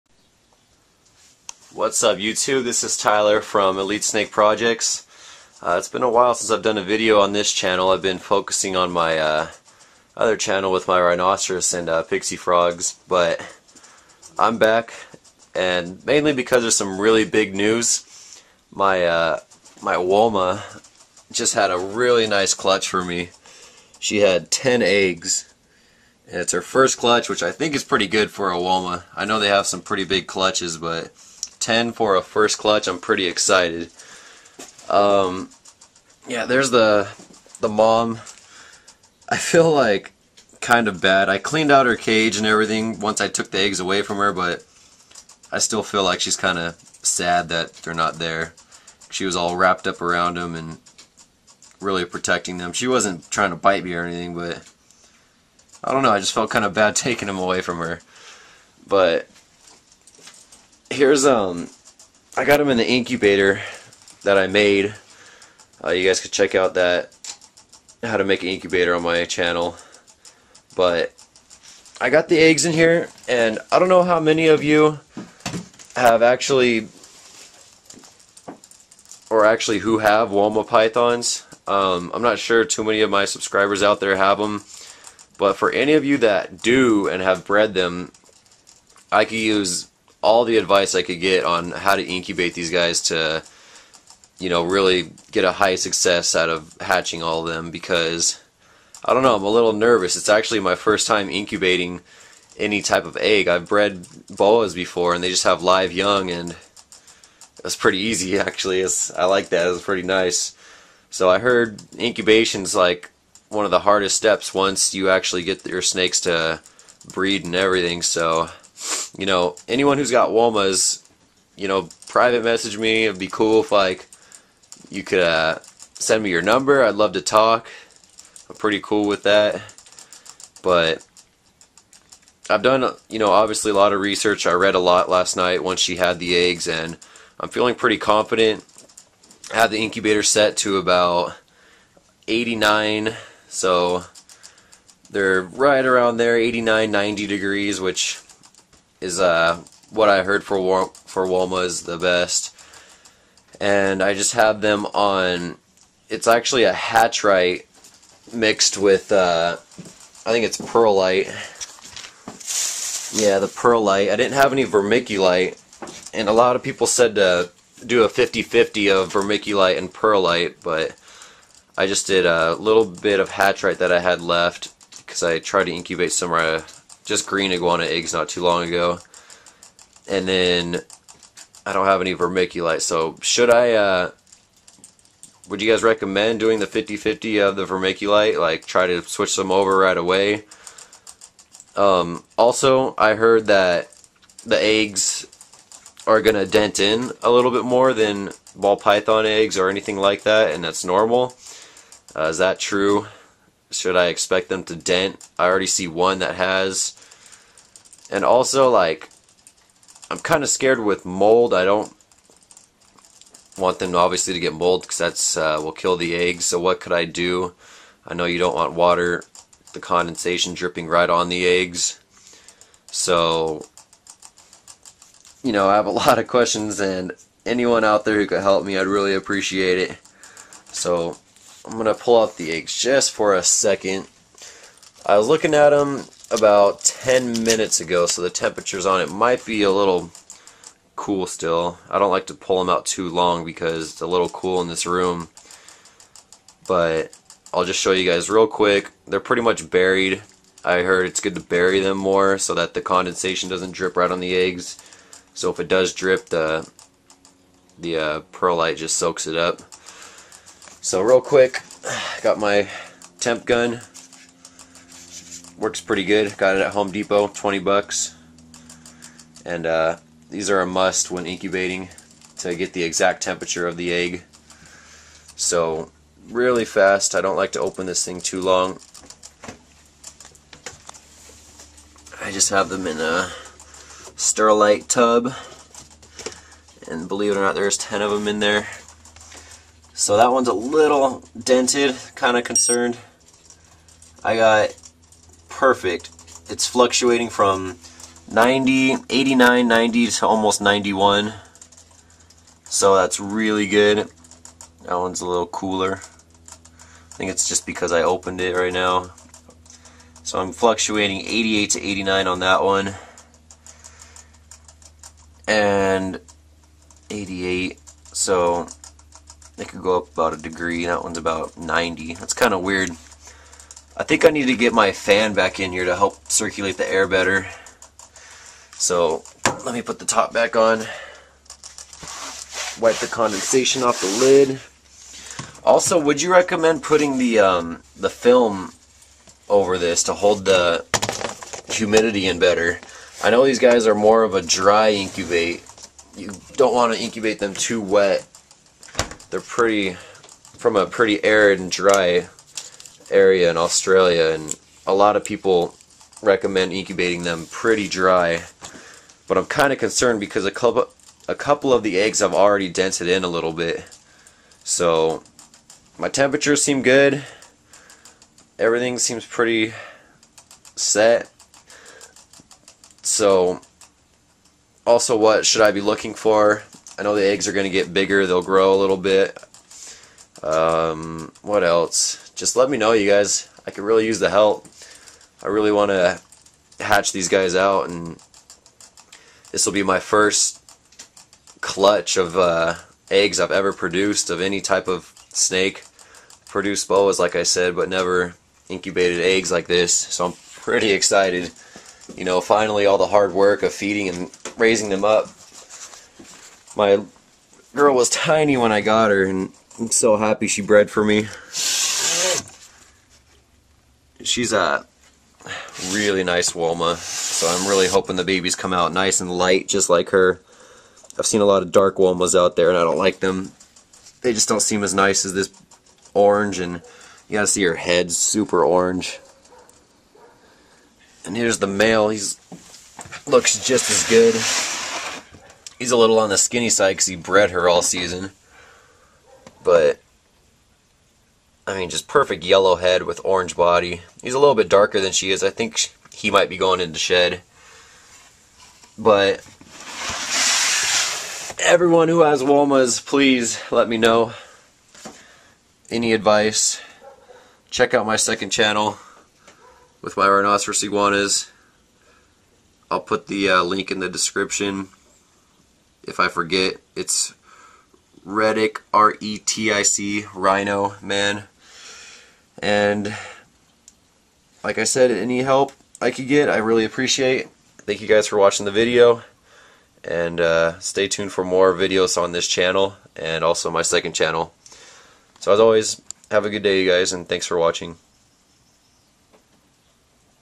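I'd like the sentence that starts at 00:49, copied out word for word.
She was all wrapped up around them and really protecting them.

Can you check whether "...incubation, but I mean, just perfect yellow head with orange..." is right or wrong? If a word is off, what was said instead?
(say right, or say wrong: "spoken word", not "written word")
wrong: "season", not "incubation".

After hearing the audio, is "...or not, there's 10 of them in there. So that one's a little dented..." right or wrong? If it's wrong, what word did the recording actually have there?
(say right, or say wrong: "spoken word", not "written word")
right.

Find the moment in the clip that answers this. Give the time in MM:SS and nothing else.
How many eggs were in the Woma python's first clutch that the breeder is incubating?
00:24.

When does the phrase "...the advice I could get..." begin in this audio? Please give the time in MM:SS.
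01:30.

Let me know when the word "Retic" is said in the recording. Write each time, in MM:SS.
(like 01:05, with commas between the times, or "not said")
07:48.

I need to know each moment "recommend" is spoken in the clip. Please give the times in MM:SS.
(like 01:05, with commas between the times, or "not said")
03:05, 05:36, 05:56.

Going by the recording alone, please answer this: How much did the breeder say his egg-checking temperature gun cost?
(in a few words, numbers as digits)
$20.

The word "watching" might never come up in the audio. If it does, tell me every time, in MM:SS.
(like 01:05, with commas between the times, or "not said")
07:58, 08:07.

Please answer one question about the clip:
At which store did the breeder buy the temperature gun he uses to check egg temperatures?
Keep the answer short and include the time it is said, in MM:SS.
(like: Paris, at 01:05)
Home Depot, at 04:26.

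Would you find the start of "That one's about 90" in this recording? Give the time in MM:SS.
05:20.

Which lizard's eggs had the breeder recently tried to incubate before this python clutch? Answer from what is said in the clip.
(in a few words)
green iguana.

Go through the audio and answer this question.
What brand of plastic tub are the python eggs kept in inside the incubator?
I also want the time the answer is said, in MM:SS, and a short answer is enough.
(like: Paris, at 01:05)
Sterilite, at 04:44.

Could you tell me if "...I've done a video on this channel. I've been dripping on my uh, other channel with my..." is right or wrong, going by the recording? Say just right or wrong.
wrong.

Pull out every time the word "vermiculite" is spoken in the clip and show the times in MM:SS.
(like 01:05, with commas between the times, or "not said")
02:44, 02:49, 03:02, 03:07.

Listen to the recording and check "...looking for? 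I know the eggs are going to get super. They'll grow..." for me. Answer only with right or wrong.
wrong.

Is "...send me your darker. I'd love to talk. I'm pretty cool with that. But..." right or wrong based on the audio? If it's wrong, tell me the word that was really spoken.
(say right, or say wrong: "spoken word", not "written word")
wrong: "number", not "darker".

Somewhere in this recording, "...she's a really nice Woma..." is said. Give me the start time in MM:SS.
06:54.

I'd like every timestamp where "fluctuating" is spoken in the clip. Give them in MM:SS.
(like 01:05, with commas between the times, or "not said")
04:56, 05:10.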